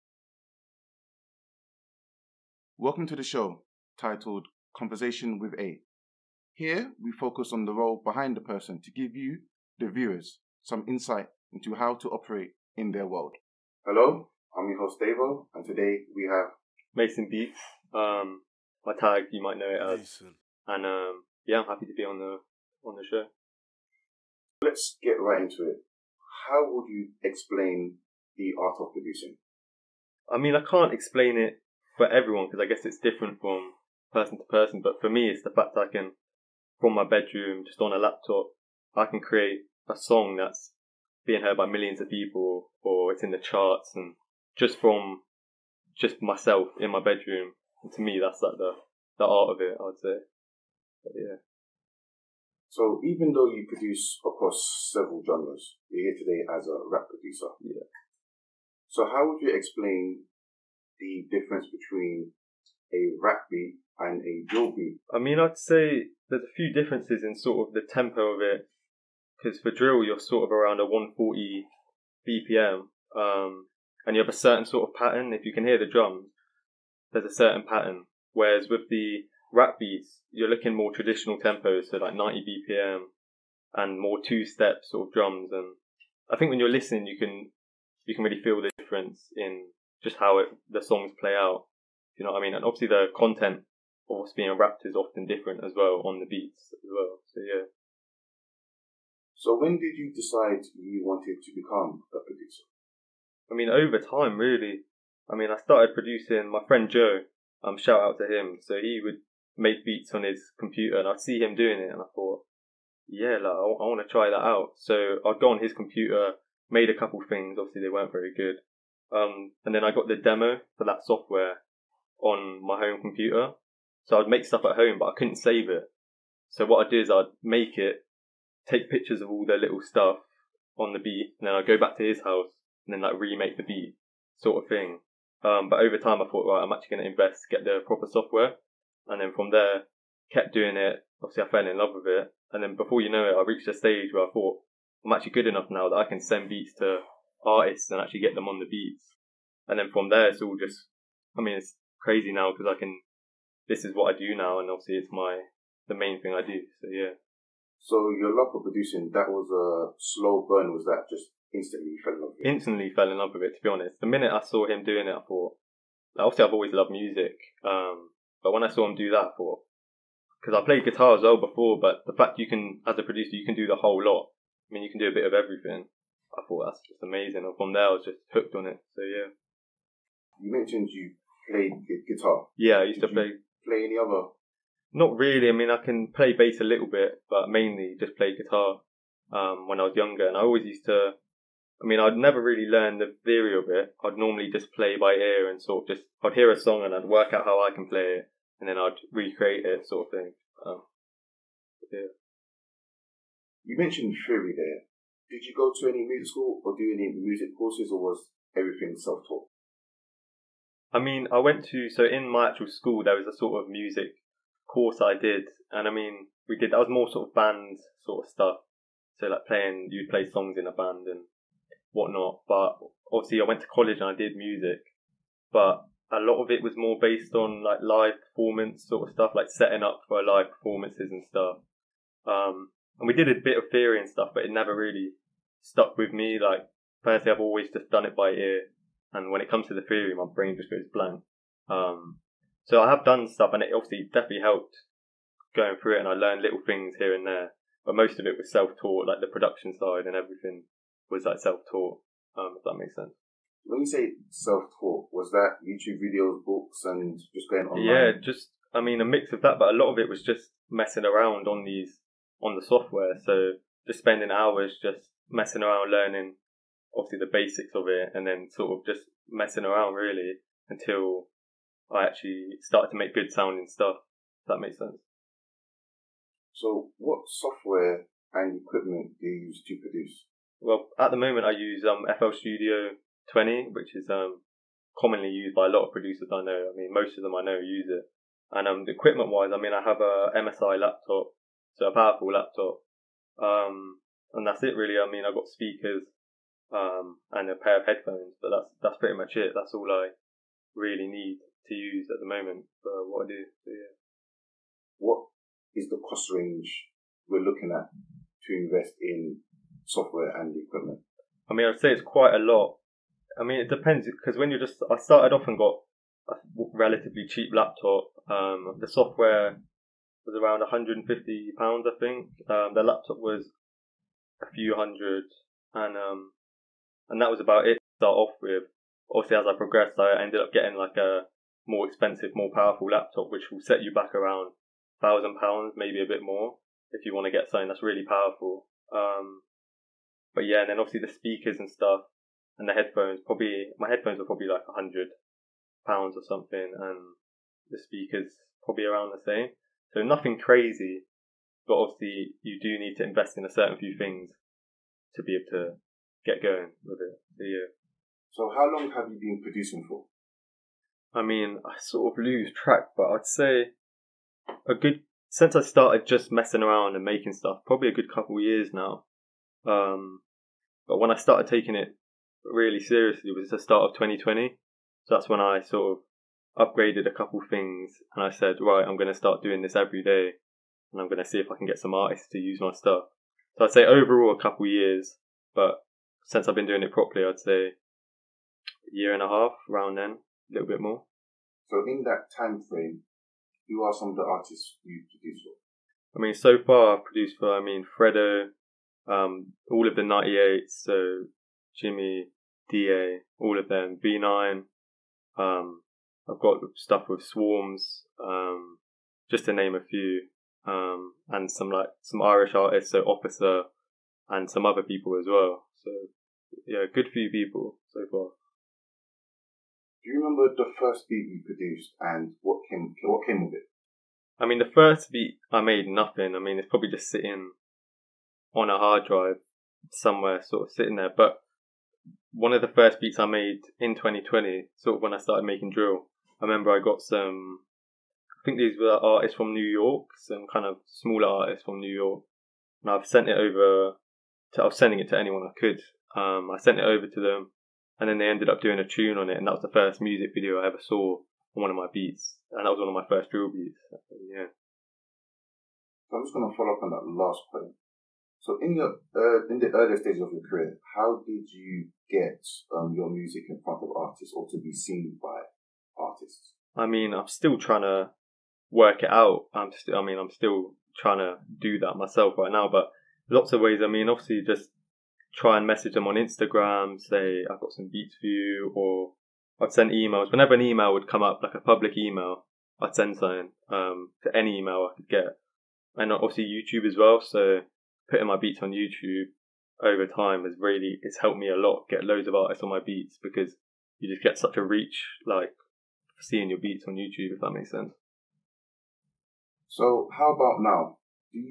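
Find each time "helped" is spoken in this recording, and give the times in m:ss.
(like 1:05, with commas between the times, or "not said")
4:04, 8:11.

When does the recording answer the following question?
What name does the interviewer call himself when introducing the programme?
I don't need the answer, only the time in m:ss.
0:15.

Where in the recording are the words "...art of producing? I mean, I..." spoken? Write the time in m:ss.
0:28.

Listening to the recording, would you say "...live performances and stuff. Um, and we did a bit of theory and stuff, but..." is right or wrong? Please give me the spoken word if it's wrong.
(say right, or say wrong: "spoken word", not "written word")
right.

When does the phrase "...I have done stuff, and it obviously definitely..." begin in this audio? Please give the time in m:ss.
4:02.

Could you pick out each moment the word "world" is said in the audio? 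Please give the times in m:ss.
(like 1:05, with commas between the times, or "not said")
0:13.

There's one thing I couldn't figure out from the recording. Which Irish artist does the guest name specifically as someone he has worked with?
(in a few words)
Officer.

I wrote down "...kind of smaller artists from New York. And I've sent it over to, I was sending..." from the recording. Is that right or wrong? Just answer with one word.
right.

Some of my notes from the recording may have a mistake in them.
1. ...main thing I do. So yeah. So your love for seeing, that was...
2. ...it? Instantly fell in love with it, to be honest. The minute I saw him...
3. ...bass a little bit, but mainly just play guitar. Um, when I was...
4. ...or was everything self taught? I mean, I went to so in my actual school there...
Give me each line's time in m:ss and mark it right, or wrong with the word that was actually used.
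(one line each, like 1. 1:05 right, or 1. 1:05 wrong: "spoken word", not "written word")
1. 2:35 wrong: "producing", not "seeing"
2. 2:42 right
3. 3:06 right
4. 3:27 right.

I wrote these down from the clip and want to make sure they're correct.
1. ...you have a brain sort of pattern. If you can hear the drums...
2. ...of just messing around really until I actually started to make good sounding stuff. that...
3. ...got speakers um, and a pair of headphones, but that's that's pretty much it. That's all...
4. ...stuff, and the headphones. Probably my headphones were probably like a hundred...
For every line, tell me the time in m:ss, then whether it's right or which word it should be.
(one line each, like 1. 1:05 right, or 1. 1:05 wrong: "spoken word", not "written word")
1. 1:14 wrong: "certain", not "brain"
2. 4:28 right
3. 4:55 right
4. 5:41 right.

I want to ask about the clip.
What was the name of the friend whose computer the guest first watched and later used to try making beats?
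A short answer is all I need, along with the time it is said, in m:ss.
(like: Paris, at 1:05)
Joe, at 1:46.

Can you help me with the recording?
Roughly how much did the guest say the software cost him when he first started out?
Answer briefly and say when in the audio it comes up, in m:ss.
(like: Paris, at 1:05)
£150, at 5:20.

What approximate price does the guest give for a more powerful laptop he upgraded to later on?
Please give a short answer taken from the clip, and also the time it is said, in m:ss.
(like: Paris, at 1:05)
£1,000, at 5:35.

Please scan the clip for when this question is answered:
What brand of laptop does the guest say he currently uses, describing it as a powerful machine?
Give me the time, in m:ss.
4:50.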